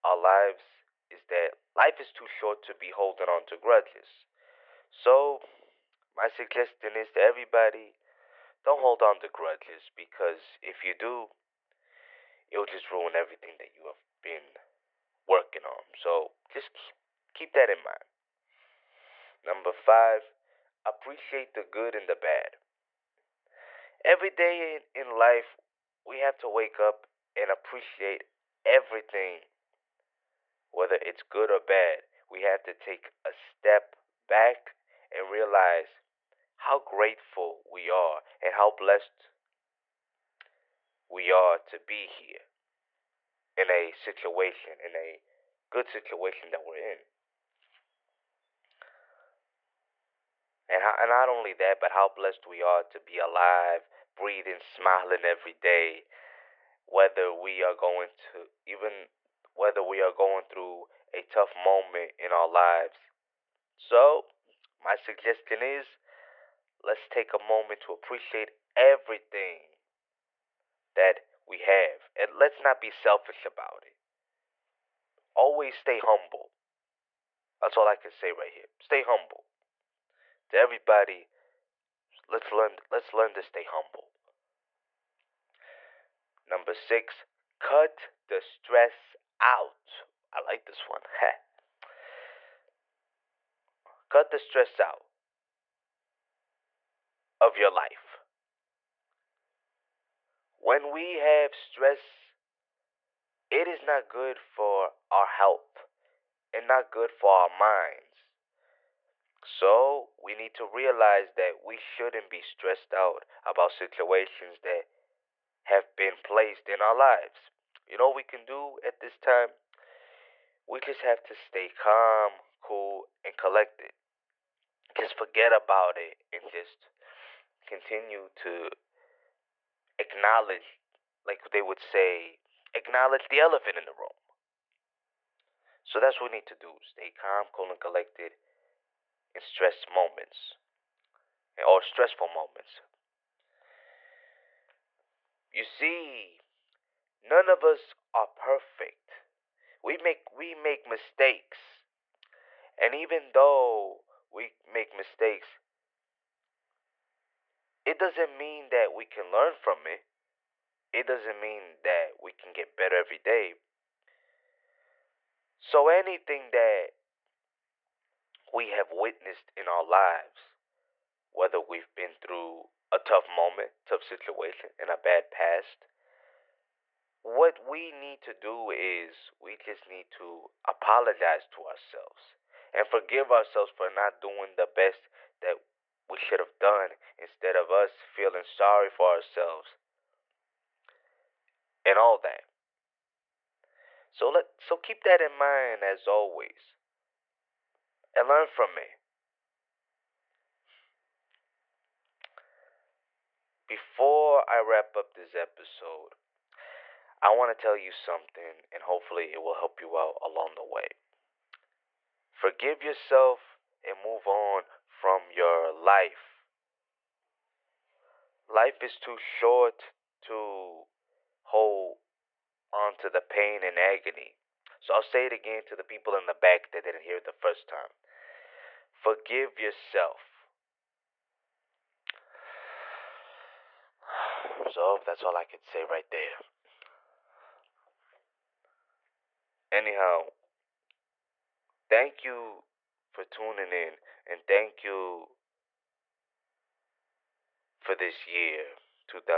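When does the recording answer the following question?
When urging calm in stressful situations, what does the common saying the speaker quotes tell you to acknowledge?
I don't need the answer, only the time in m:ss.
2:13.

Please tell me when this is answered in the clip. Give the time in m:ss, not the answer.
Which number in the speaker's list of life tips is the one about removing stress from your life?
1:26.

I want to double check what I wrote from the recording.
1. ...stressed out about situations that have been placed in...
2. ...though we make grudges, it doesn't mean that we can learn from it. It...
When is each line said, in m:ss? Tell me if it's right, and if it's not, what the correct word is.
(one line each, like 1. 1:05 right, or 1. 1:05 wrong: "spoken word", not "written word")
1. 1:52 right
2. 2:33 wrong: "mistakes", not "grudges".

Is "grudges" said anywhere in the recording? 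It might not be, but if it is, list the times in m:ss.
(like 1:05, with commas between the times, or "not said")
0:03, 0:09.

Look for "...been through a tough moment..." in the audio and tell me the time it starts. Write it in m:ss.
2:51.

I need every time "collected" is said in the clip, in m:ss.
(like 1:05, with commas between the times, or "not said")
2:03, 2:17.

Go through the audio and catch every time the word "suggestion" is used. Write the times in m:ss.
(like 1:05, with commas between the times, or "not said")
0:06, 1:04.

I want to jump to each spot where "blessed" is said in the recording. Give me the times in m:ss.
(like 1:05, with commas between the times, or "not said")
0:38, 0:52.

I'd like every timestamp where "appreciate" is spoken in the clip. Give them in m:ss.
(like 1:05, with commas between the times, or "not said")
0:20, 0:27, 1:07.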